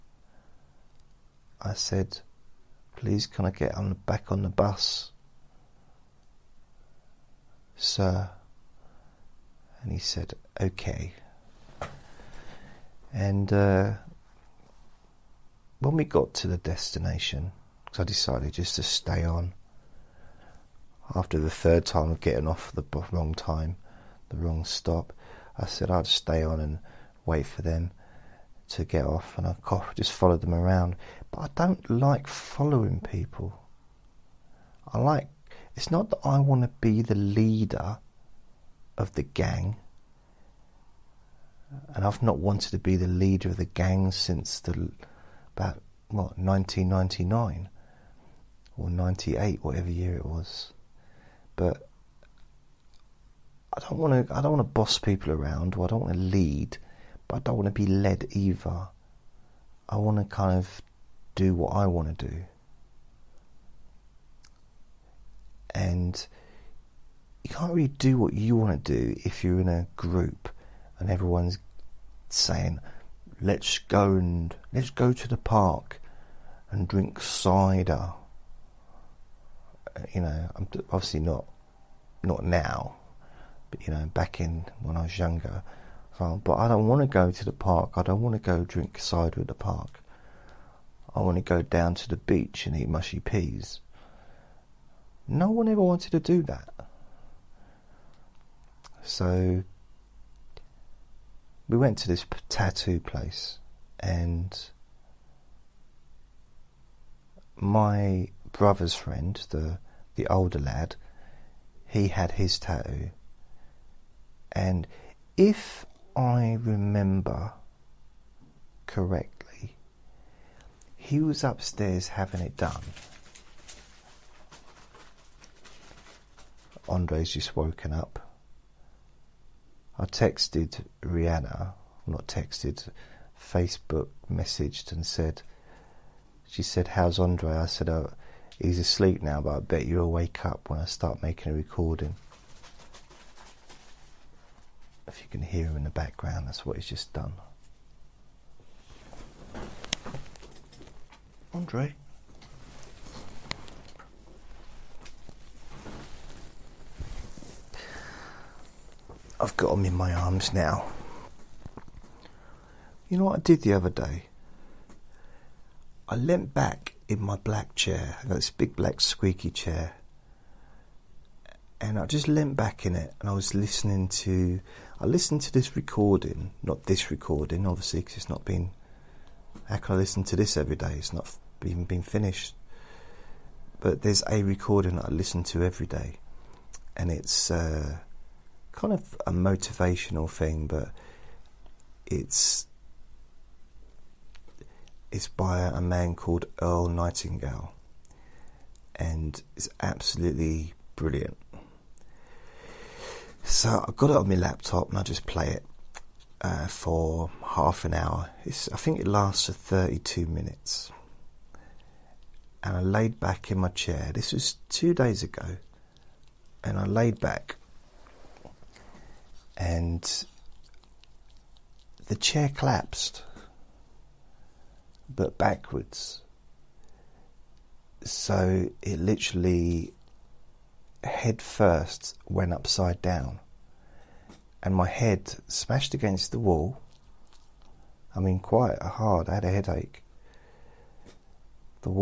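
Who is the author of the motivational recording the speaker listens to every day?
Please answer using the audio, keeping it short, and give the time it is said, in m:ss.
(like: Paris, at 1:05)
Earl Nightingale, at 3:16.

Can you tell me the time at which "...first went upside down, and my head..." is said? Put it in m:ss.
3:51.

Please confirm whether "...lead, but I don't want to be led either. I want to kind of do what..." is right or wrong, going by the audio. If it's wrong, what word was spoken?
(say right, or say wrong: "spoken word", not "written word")
right.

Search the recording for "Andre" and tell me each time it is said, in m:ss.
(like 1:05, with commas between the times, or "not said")
2:06, 2:17, 2:31.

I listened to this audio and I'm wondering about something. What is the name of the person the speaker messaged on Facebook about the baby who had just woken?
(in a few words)
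Rihanna.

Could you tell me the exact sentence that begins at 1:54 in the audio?
And if I remember correctly, he was upstairs having it done.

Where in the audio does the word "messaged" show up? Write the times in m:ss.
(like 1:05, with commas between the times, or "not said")
2:14.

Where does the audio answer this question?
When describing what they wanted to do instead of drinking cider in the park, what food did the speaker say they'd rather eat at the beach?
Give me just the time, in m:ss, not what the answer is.
1:32.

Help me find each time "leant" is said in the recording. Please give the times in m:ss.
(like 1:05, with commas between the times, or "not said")
2:46, 2:52.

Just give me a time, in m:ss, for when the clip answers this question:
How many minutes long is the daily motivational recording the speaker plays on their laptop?
3:29.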